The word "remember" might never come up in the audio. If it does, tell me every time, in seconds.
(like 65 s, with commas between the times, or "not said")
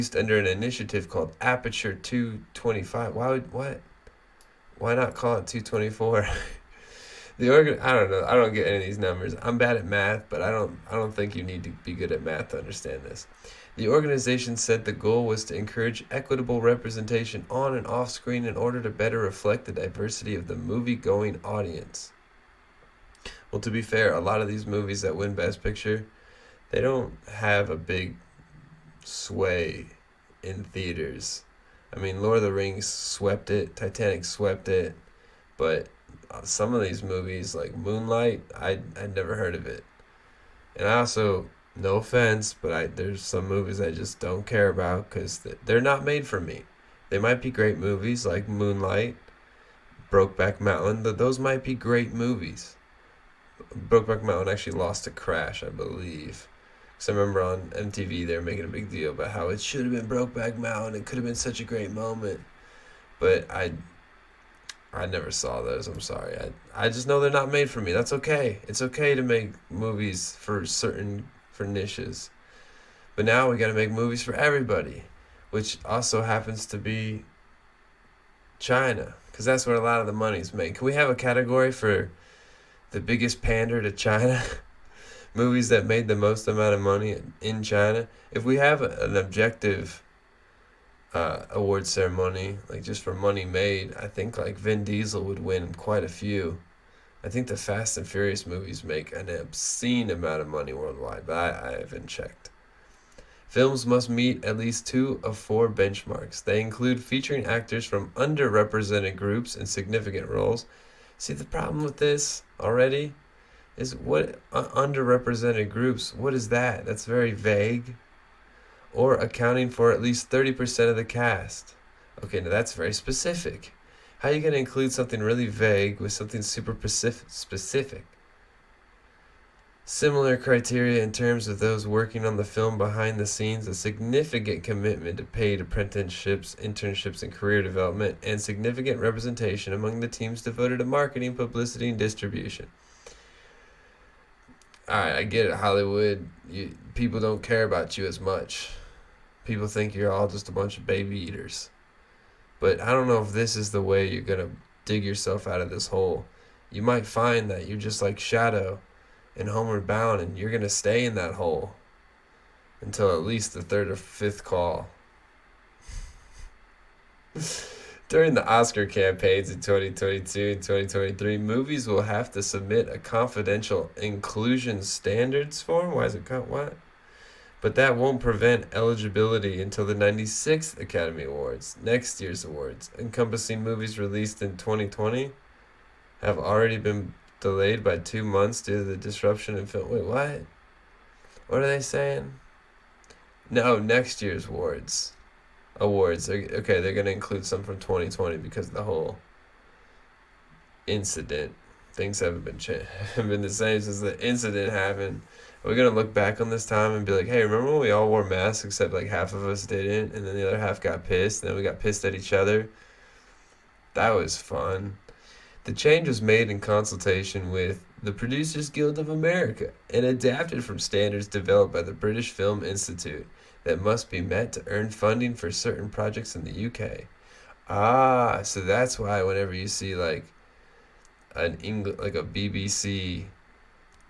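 57 s, 207 s.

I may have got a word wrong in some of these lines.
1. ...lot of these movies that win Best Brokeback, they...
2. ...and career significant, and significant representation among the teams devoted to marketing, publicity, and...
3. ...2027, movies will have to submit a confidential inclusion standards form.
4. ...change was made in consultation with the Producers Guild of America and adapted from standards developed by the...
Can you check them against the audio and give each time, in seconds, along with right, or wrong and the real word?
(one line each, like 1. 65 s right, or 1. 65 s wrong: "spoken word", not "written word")
1. 24 s wrong: "Picture", not "Brokeback"
2. 137 s wrong: "development", not "significant"
3. 170 s wrong: "2023", not "2027"
4. 215 s right.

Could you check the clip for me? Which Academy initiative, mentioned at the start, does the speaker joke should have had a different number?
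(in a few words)
Aperture 225.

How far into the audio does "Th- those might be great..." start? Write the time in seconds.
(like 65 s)
51 s.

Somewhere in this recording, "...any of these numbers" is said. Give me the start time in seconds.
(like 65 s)
8 s.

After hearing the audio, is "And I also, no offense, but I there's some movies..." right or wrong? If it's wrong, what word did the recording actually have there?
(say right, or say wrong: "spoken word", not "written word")
right.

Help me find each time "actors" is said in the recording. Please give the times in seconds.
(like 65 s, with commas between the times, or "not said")
107 s.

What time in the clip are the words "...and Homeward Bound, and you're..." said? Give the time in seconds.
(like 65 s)
159 s.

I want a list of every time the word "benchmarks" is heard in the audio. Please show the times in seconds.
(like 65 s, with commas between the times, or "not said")
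105 s.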